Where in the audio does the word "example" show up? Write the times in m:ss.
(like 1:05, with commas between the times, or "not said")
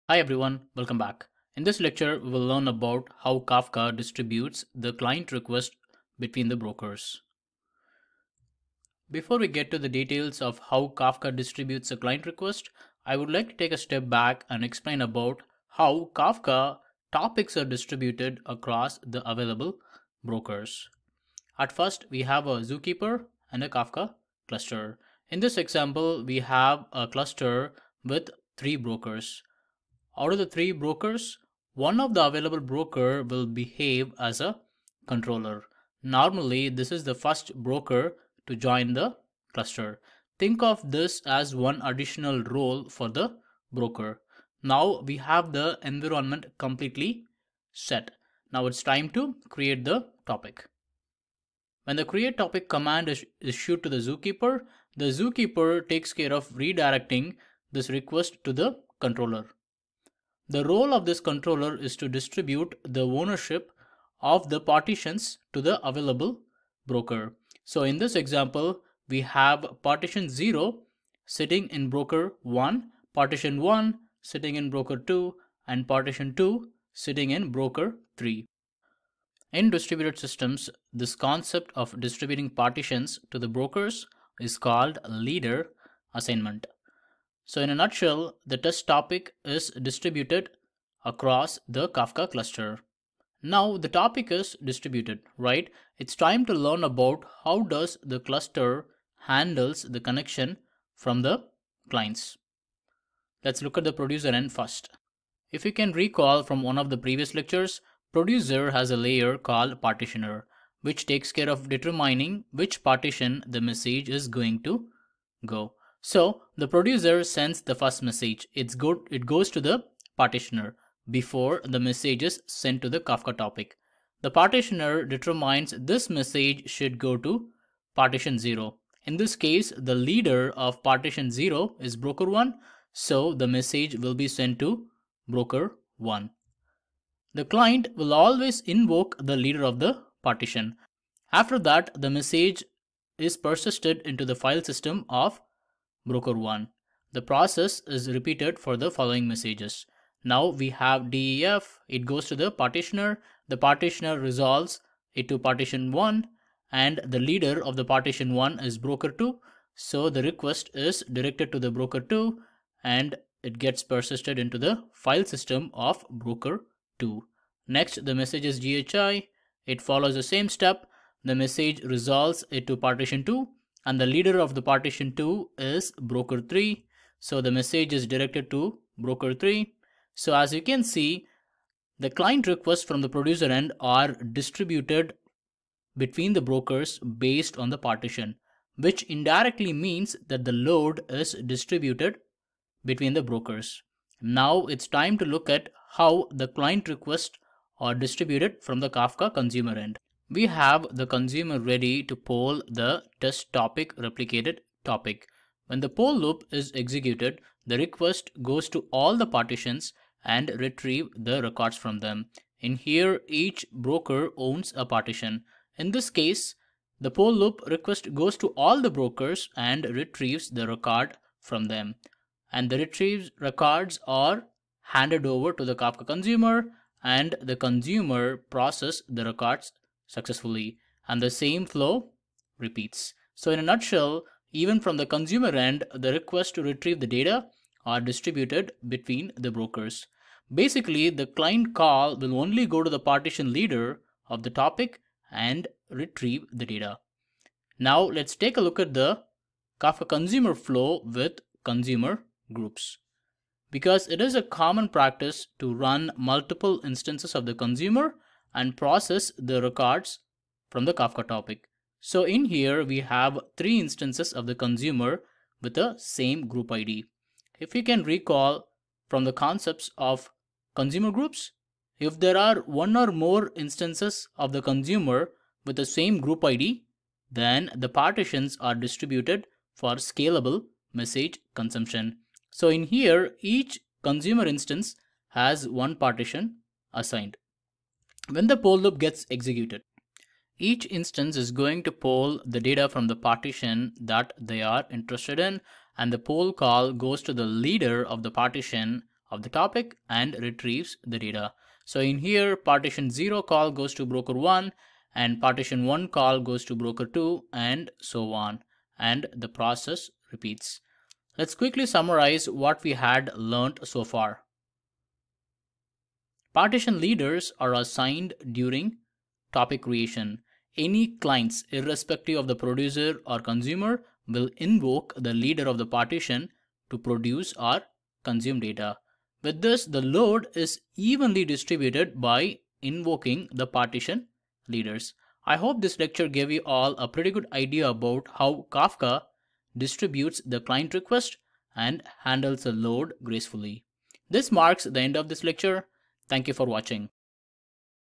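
0:25, 1:08.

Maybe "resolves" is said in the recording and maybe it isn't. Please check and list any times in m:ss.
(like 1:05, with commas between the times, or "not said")
2:34, 2:51.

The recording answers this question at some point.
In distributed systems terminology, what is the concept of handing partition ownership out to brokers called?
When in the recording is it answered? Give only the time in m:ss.
1:25.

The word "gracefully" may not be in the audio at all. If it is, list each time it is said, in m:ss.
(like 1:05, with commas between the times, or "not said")
5:43.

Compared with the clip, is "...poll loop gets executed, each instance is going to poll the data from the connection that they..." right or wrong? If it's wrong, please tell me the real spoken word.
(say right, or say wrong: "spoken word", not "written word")
wrong: "partition", not "connection".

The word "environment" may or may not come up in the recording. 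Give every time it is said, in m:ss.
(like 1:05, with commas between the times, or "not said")
0:45.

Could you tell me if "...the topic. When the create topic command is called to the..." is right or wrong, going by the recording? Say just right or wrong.
wrong.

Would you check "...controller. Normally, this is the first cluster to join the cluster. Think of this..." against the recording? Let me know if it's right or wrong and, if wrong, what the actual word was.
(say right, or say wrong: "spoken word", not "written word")
wrong: "broker", not "cluster".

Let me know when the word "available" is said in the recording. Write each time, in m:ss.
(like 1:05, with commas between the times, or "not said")
0:19, 0:32, 1:05.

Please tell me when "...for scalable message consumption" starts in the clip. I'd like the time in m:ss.
4:39.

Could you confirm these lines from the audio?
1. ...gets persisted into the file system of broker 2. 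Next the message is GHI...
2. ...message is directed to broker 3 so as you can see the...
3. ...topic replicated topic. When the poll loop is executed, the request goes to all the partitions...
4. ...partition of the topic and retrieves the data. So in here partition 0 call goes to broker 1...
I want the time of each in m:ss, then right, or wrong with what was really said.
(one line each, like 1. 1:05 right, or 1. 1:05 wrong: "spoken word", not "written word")
1. 2:43 right
2. 2:57 right
3. 3:23 right
4. 4:58 right.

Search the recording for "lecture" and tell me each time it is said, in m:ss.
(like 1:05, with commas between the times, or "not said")
0:01, 1:47, 5:35, 5:45.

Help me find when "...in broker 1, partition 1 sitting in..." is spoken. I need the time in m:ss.
1:11.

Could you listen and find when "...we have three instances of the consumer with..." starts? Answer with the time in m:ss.
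4:22.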